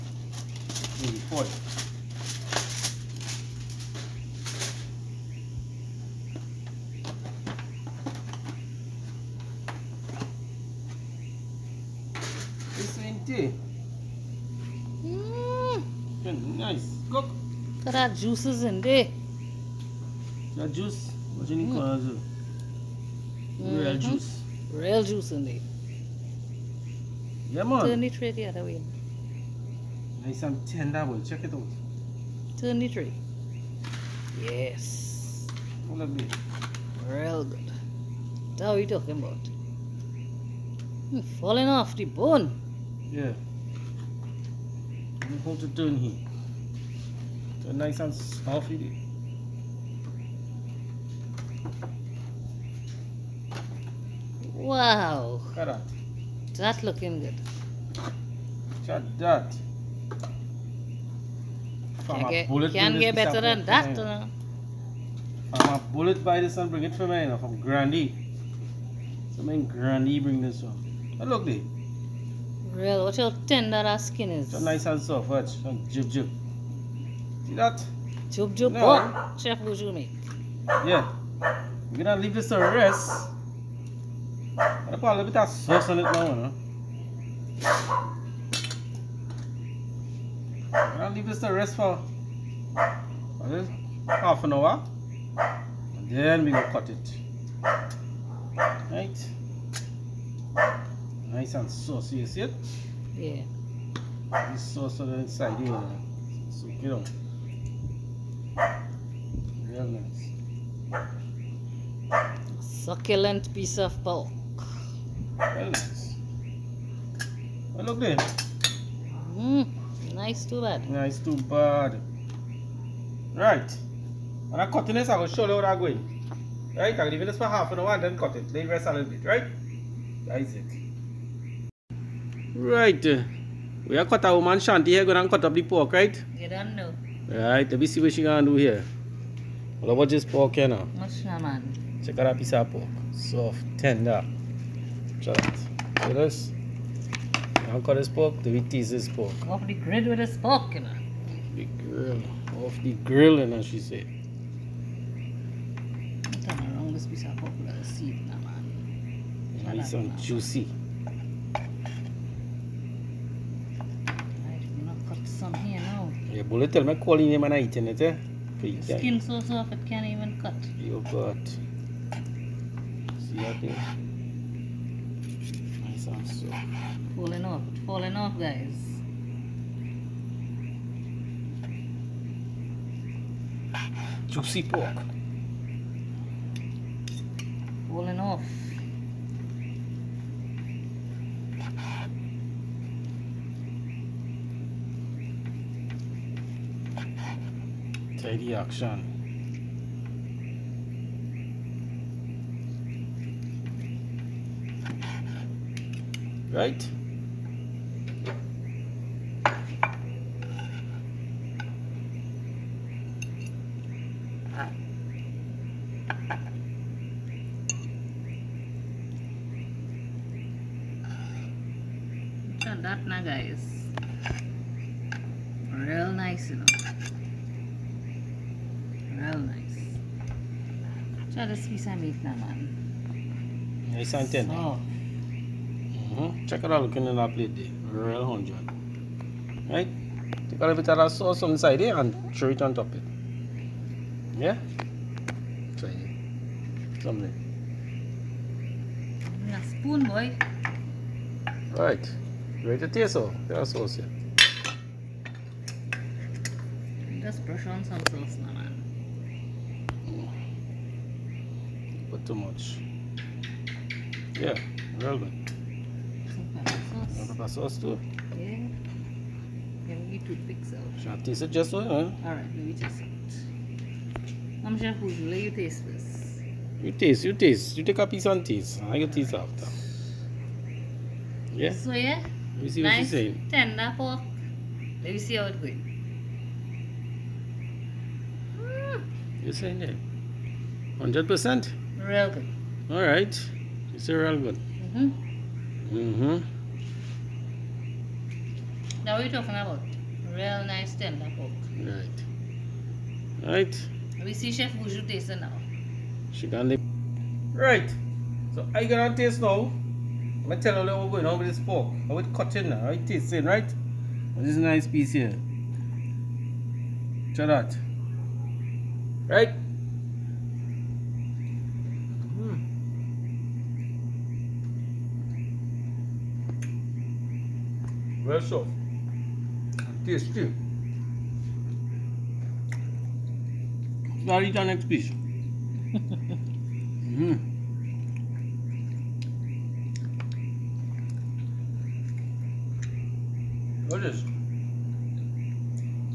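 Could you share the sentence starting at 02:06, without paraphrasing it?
Right, I'll leave this for half an hour and then cut it.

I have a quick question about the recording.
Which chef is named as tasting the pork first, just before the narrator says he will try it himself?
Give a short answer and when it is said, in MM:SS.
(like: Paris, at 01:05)
Chef Buju, at 05:04.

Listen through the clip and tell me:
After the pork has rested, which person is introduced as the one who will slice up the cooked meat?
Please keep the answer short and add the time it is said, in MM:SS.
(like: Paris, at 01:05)
Shanti, at 02:14.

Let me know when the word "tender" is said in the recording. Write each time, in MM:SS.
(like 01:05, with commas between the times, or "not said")
00:30, 01:13, 02:23, 04:43, 05:00.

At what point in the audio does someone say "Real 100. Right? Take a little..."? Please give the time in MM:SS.
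03:57.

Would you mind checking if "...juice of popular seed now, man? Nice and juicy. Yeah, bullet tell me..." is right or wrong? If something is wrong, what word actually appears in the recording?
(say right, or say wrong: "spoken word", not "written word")
wrong: "piece", not "juice".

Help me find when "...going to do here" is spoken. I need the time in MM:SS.
02:18.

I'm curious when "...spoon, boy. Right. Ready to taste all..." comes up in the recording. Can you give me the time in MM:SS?
04:09.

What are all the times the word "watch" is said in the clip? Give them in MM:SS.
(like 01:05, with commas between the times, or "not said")
01:15.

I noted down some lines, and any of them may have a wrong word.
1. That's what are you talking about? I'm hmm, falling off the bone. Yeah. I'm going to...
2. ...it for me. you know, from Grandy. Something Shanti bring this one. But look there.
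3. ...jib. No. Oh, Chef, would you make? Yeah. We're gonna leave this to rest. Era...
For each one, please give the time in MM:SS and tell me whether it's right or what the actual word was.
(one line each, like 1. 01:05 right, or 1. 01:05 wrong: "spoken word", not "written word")
1. 00:38 right
2. 01:06 wrong: "Grandy", not "Shanti"
3. 01:18 right.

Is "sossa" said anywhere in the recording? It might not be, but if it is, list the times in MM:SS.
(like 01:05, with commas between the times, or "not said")
01:25.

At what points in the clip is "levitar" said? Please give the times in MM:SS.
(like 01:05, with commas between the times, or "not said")
01:25.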